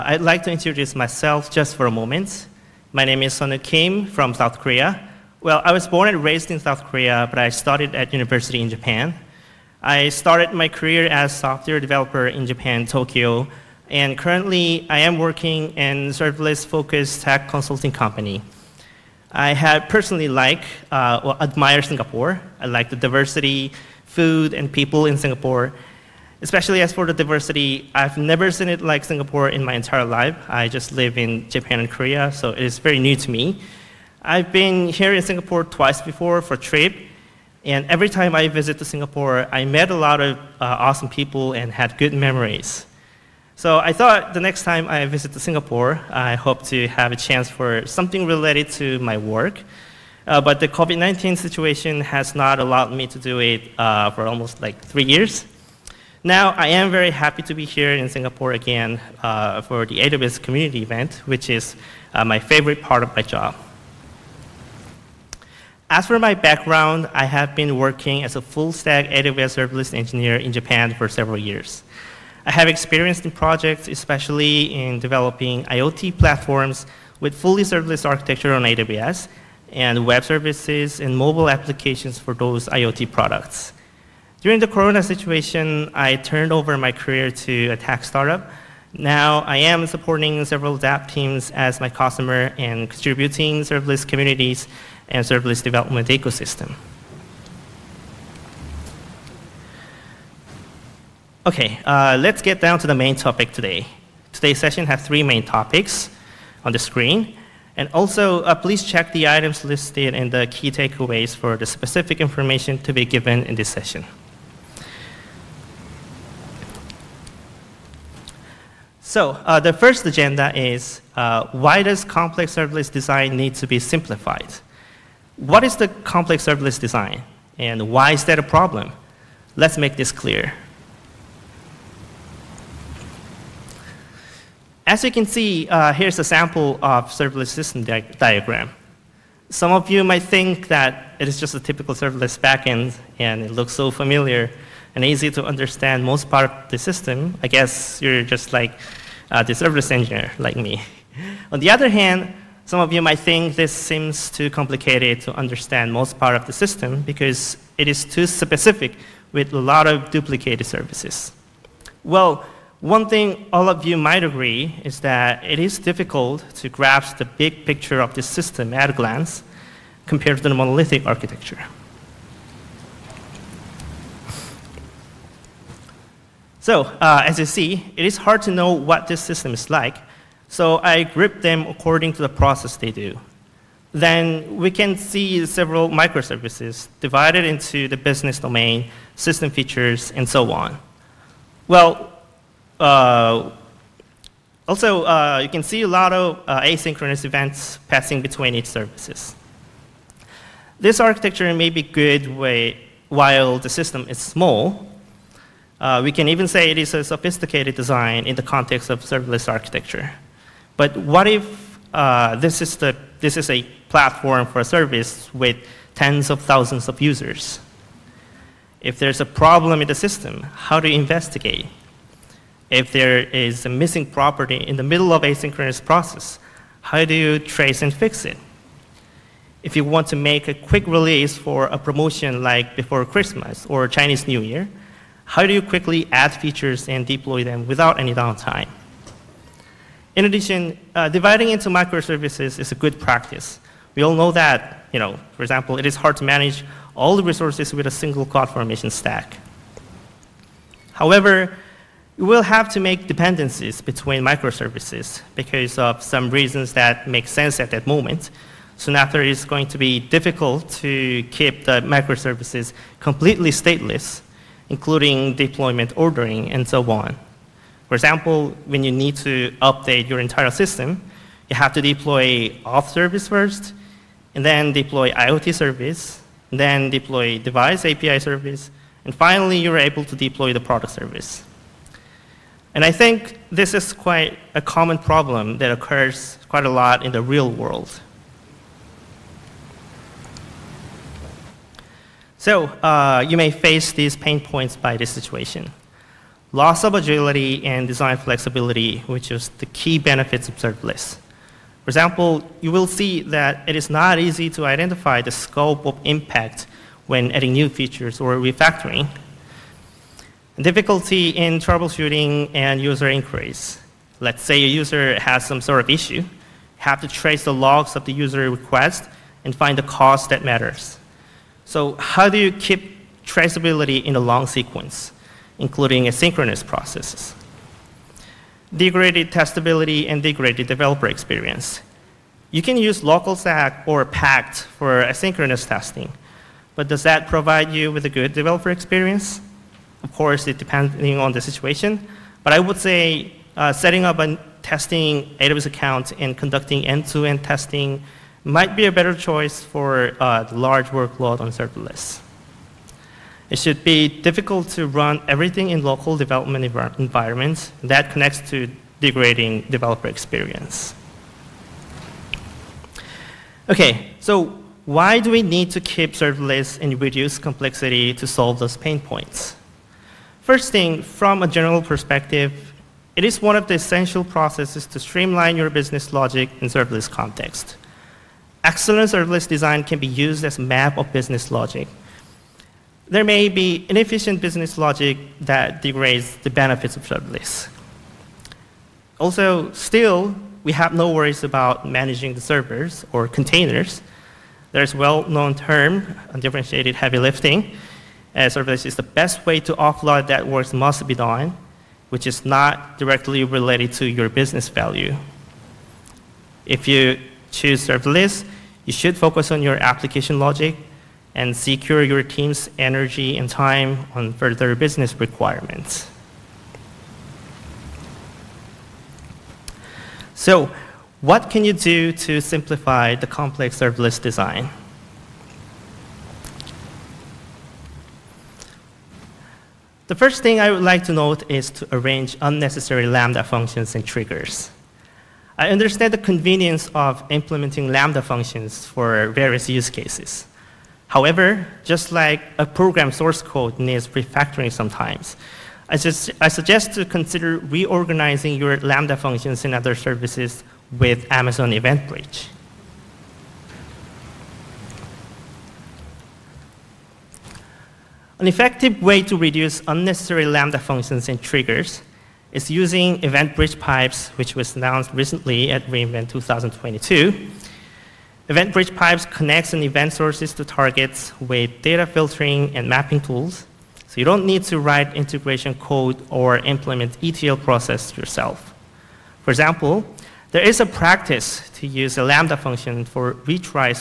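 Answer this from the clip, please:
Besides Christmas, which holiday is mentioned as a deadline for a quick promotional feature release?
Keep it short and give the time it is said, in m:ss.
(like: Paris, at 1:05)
Chinese New Year, at 3:53.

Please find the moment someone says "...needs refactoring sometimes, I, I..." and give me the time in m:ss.
7:23.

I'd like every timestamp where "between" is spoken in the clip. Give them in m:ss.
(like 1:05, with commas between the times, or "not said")
3:18, 4:13.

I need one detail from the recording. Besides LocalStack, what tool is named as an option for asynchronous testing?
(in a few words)
Pact.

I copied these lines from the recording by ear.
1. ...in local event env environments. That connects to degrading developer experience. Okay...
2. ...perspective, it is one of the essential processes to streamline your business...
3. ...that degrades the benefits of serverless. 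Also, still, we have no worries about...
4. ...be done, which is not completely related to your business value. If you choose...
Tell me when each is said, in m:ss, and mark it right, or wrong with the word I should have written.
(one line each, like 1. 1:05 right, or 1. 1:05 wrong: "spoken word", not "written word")
1. 5:55 wrong: "development", not "event"
2. 6:11 right
3. 6:25 right
4. 6:41 wrong: "directly", not "completely".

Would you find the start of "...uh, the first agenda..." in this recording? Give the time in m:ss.
1:59.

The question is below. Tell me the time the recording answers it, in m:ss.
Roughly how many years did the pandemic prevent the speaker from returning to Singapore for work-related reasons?
0:54.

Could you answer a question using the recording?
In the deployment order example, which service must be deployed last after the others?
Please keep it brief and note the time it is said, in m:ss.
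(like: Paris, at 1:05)
product service, at 4:40.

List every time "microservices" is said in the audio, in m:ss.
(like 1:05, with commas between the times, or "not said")
3:05, 4:01, 4:14, 4:21.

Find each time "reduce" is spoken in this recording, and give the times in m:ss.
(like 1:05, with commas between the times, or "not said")
6:07, 7:39.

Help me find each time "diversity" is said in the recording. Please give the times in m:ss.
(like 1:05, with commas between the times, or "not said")
0:22, 0:27.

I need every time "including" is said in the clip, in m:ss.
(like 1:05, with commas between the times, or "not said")
4:24, 5:25.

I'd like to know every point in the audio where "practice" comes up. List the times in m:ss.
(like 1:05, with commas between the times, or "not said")
4:02, 8:00.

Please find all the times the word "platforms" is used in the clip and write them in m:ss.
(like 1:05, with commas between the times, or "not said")
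1:16, 3:33.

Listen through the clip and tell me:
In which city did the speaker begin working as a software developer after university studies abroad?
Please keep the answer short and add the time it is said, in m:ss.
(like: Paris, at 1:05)
Tokyo, at 0:12.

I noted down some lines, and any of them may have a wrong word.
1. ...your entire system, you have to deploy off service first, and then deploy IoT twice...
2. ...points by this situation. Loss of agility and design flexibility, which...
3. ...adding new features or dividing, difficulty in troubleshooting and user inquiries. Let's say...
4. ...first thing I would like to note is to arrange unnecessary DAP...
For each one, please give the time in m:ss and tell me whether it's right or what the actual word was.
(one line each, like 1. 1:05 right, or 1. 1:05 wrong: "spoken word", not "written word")
1. 4:30 wrong: "service", not "twice"
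2. 4:54 right
3. 5:07 wrong: "refactoring", not "dividing"
4. 7:10 wrong: "Lambda", not "DAP".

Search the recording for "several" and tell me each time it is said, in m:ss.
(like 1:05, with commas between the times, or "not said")
1:11, 1:30, 3:05.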